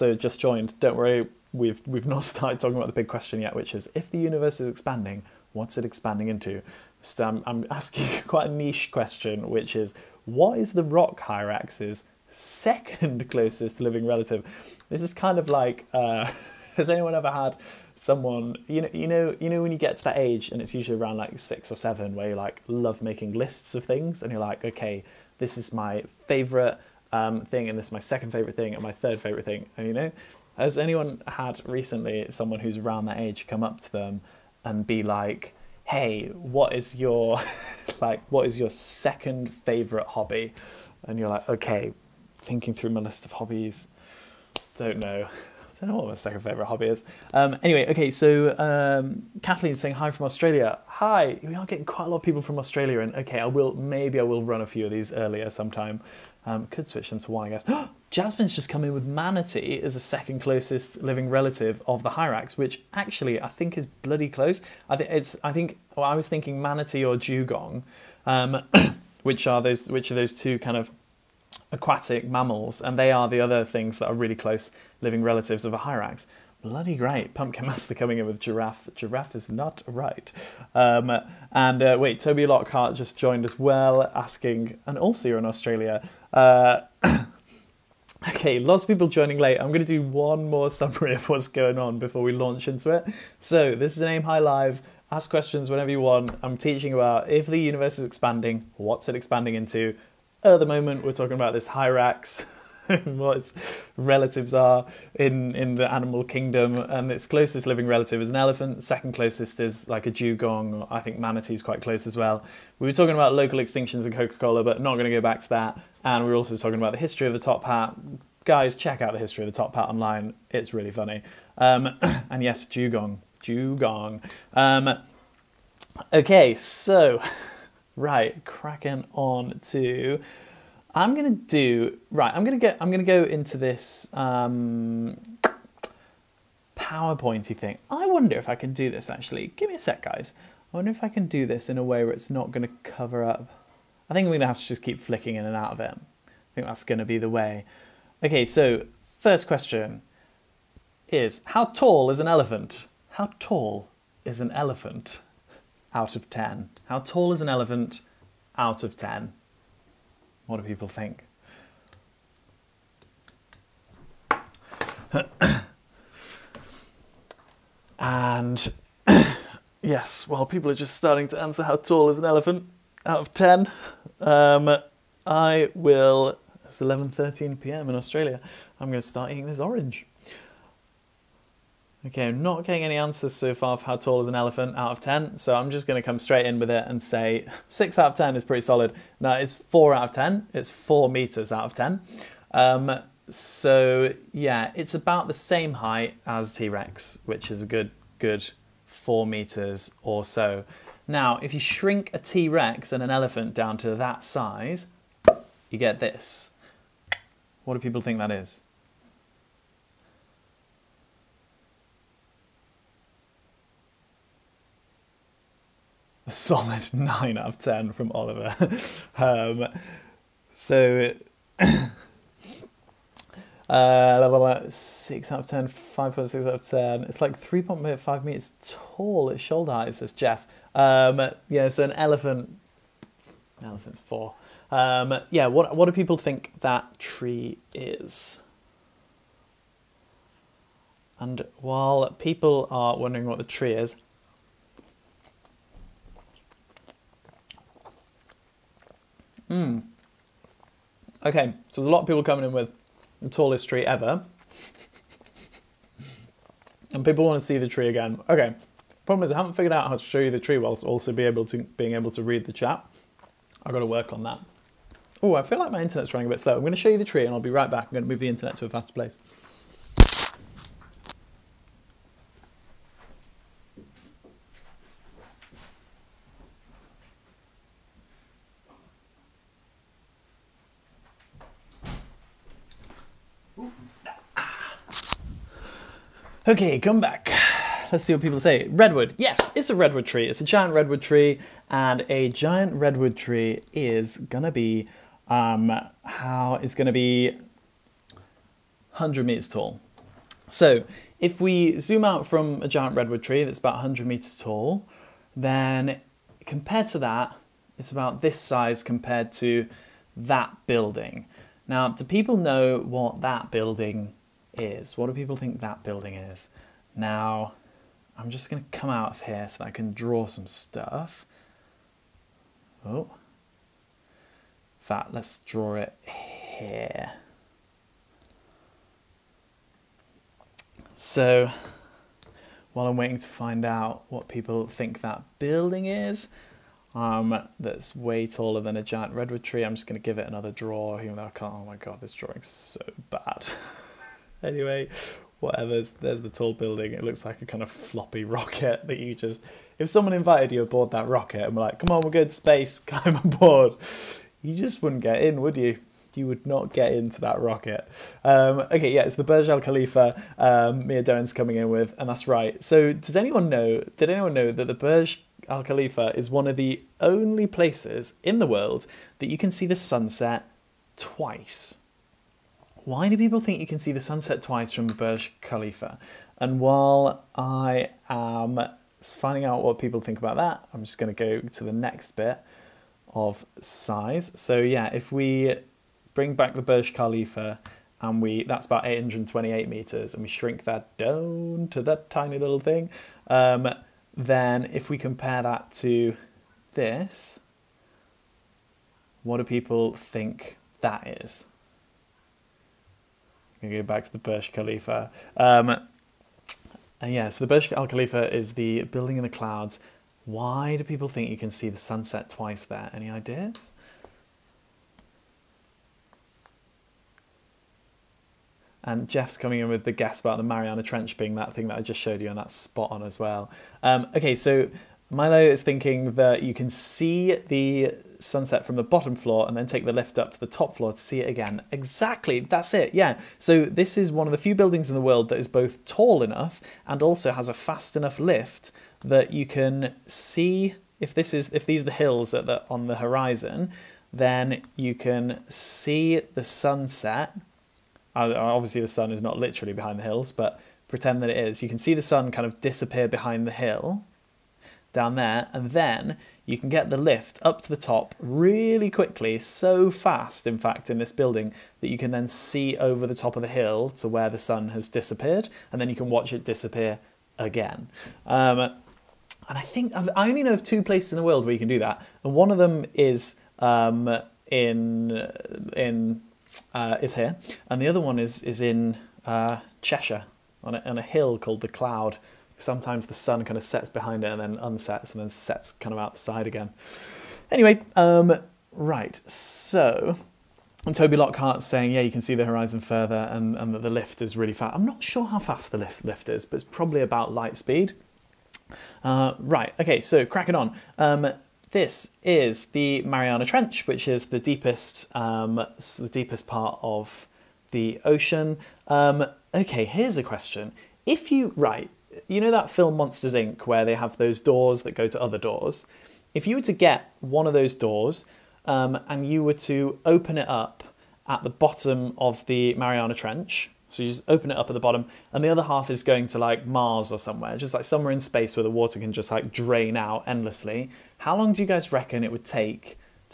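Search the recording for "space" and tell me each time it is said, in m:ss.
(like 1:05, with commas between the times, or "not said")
5:52, 8:48.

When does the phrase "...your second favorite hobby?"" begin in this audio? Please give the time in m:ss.
0:38.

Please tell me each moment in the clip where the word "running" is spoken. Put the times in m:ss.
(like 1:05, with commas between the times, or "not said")
4:26.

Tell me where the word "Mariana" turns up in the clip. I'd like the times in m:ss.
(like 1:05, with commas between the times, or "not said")
7:00, 8:23, 8:42.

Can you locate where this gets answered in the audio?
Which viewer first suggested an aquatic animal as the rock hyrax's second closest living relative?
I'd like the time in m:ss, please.
0:58.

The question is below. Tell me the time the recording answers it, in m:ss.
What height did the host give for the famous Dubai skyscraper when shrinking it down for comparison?
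6:28.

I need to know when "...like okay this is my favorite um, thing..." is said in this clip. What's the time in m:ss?
0:24.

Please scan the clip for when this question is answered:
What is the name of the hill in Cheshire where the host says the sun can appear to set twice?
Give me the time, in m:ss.
8:01.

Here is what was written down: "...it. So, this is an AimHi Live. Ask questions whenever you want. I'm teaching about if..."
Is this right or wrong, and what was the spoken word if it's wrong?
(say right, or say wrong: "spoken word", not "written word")
right.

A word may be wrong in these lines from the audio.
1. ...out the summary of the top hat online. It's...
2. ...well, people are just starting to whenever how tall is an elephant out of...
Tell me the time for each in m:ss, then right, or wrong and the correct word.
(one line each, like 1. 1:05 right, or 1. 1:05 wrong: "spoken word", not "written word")
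1. 1:59 wrong: "history", not "summary"
2. 2:50 wrong: "answer", not "whenever".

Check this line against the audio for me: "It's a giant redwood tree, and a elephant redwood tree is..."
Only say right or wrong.
wrong.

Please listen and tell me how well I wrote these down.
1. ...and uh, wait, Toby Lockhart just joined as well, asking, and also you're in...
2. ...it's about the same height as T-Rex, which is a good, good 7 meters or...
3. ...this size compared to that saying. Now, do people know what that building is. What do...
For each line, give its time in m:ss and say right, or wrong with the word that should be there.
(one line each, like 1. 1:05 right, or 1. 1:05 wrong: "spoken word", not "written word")
1. 1:21 right
2. 3:14 wrong: "4", not "7"
3. 5:08 wrong: "building", not "saying".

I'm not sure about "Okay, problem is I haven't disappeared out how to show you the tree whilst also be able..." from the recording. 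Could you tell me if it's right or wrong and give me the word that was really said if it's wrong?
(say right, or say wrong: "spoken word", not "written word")
wrong: "figured", not "disappeared".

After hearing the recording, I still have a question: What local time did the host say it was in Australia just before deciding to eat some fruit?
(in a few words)
11:13pm.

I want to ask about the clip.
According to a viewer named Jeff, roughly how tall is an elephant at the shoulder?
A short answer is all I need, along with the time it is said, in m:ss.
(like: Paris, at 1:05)
3.5 meters, at 3:47.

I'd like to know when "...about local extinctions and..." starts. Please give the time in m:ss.
1:53.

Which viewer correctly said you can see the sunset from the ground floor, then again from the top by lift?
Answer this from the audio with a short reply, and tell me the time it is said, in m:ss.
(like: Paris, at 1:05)
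Milo, at 7:05.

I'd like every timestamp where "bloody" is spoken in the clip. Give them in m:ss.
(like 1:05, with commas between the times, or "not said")
1:03, 1:16.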